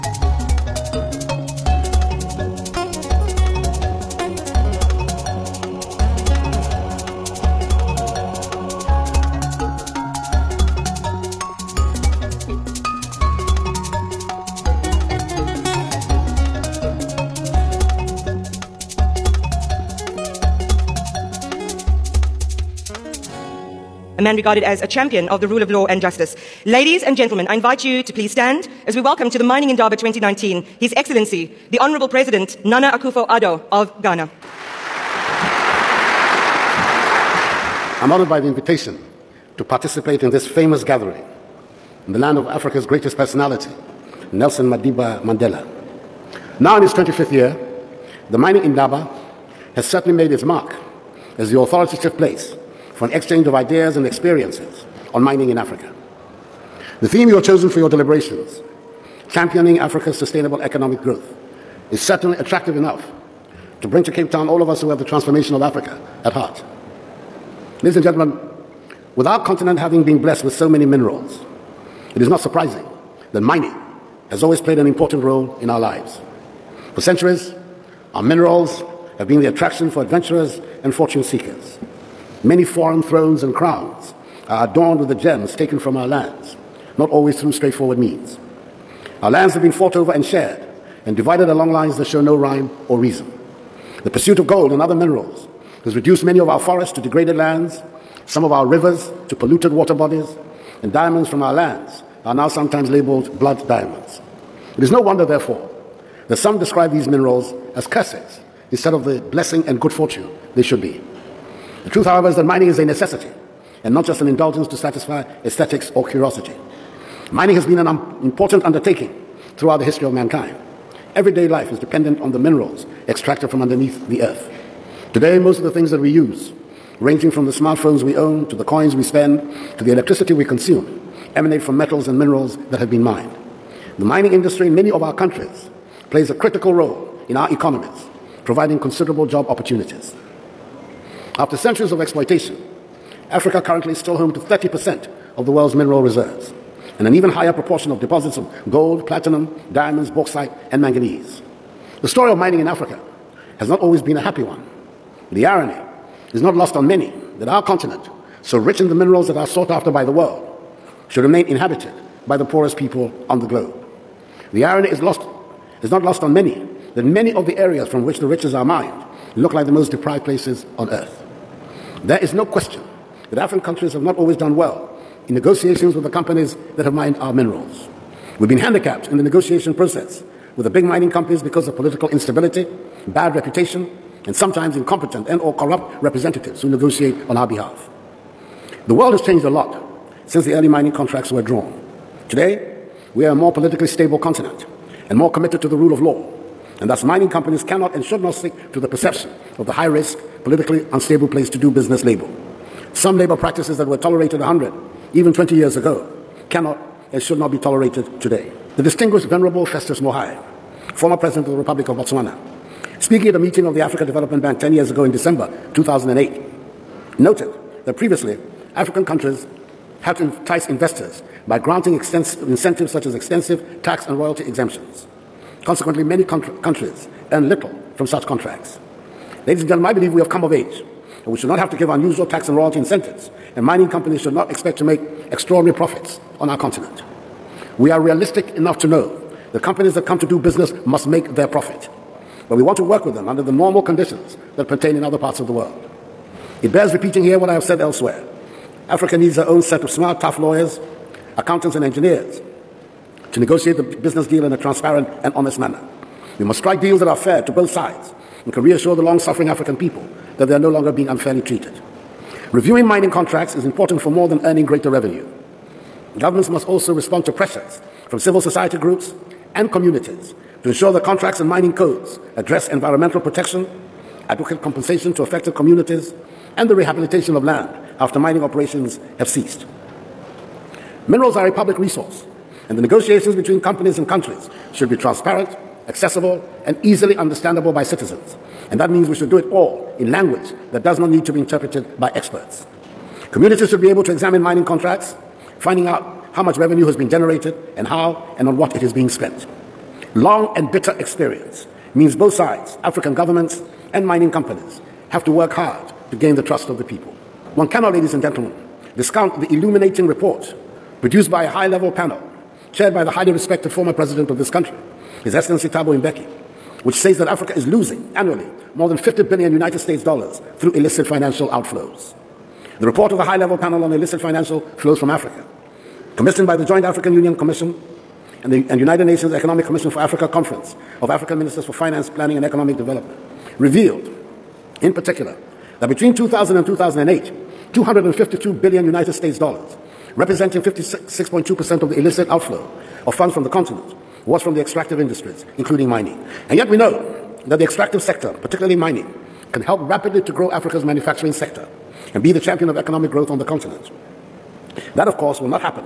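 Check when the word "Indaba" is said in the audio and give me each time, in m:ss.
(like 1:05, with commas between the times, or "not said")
0:29, 0:48.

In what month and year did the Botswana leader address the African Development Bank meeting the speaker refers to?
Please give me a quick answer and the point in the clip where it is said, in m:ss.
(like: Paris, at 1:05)
December 2008, at 3:35.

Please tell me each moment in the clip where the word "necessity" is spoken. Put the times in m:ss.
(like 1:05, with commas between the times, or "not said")
1:52.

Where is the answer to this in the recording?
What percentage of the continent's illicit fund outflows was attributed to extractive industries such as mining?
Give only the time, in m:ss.
5:40.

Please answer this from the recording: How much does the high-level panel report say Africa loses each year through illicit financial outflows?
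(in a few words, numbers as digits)
more than 50 billion US dollars.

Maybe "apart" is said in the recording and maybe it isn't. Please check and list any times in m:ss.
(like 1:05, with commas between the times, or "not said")
not said.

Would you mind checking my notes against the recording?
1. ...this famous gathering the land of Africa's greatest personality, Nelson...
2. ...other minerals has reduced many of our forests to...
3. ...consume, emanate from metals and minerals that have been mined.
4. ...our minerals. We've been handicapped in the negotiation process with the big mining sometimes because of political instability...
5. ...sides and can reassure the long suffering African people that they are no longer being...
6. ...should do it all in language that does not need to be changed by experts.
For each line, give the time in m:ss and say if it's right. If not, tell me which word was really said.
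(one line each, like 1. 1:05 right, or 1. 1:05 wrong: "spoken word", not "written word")
1. 0:40 right
2. 1:34 right
3. 2:10 right
4. 2:57 wrong: "companies", not "sometimes"
5. 4:17 right
6. 4:49 wrong: "interpreted", not "changed".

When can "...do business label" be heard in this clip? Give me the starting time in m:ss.
3:21.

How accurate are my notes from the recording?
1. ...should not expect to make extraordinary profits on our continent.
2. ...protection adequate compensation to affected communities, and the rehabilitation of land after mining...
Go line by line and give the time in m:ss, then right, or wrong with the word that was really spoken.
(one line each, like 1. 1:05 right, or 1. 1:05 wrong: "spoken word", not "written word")
1. 3:54 right
2. 4:33 right.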